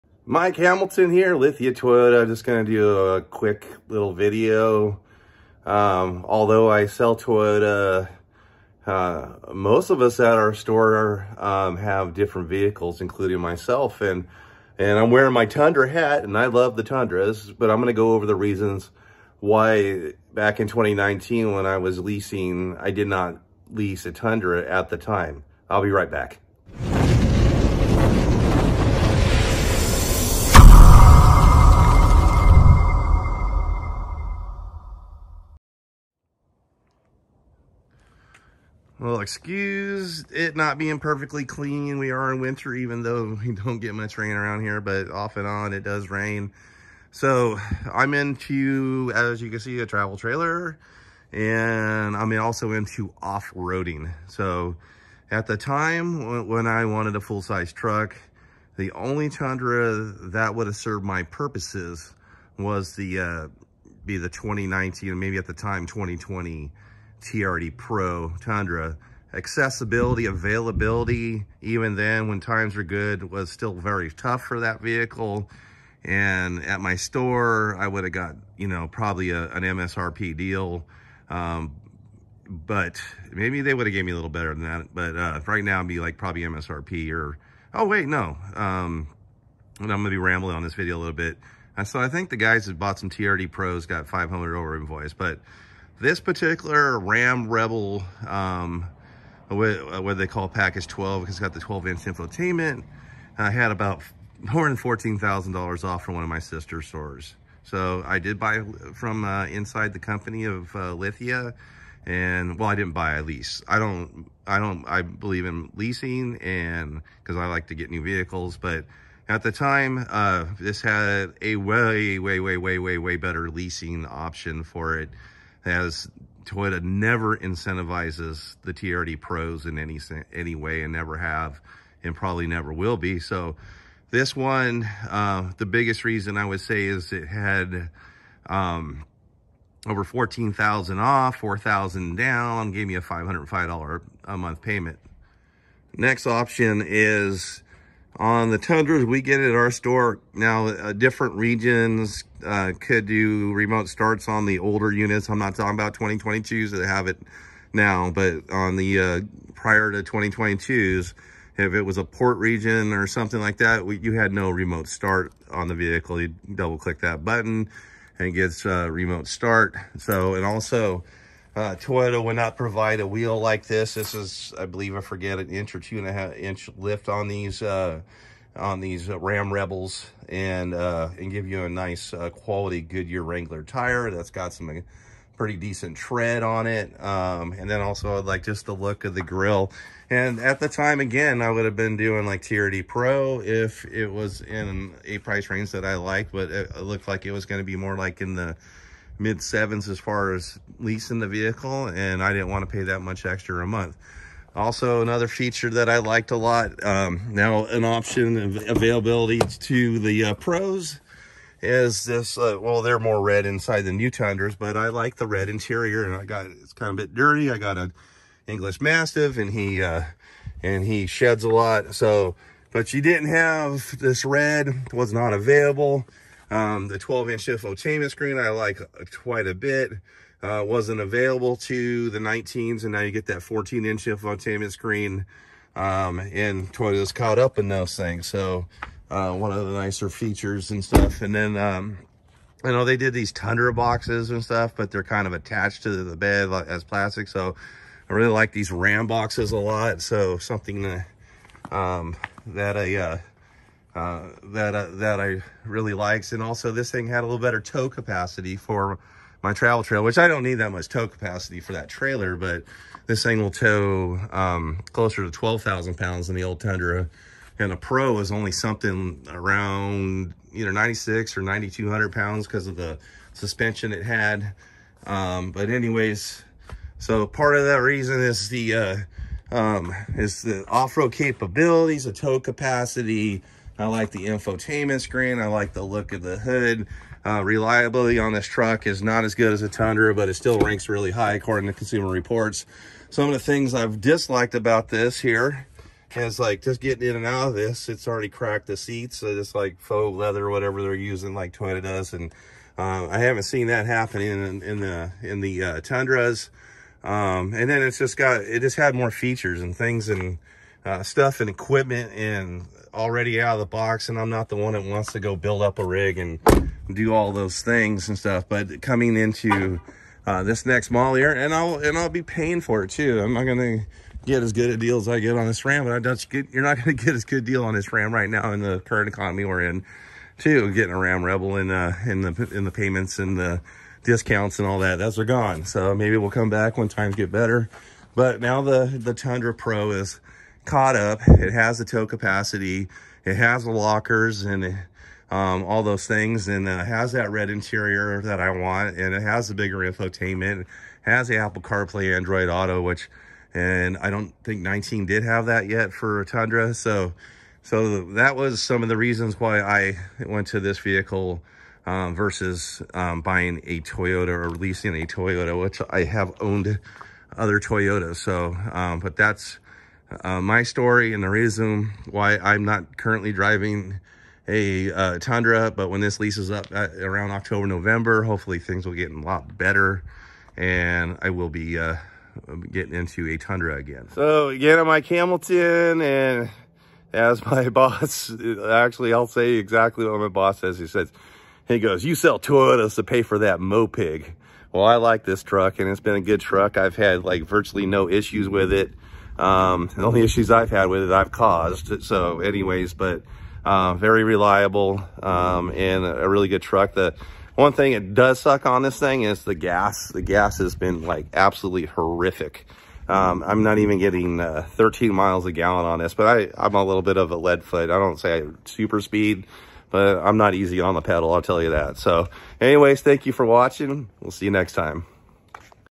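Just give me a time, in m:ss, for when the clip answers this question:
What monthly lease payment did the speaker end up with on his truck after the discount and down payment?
2:23.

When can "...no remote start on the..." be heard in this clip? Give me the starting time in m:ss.
2:44.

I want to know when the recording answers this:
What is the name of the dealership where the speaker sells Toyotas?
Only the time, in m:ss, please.
0:01.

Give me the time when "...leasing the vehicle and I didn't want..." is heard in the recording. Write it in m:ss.
3:20.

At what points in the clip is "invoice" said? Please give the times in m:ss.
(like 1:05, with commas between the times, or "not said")
1:34.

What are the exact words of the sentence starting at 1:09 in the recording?
Accessibility, availability, even then when times were good, was still very tough for that vehicle.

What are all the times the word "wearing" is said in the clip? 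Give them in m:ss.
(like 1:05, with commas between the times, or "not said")
0:15.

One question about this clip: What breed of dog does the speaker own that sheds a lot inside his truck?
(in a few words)
English Mastiff.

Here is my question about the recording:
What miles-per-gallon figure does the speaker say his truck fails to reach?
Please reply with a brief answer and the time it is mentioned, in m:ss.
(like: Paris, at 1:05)
13, at 6:54.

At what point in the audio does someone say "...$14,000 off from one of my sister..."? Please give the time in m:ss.
1:44.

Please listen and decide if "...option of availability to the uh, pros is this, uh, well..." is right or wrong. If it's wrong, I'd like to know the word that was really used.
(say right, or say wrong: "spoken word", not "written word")
right.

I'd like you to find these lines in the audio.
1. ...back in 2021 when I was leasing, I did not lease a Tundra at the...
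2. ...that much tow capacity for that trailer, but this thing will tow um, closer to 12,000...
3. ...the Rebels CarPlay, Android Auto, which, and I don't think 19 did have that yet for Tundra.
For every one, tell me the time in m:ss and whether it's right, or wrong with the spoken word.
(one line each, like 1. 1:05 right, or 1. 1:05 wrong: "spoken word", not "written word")
1. 0:20 wrong: "2019", not "2021"
2. 4:20 right
3. 5:51 wrong: "Apple", not "Rebels".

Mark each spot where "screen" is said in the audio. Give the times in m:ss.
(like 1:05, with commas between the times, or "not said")
3:48, 3:54, 4:45.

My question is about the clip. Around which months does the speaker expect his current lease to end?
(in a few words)
October, November.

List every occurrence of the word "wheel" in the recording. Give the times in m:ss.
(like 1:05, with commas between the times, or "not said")
2:53.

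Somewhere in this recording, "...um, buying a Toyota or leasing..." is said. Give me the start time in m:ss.
6:02.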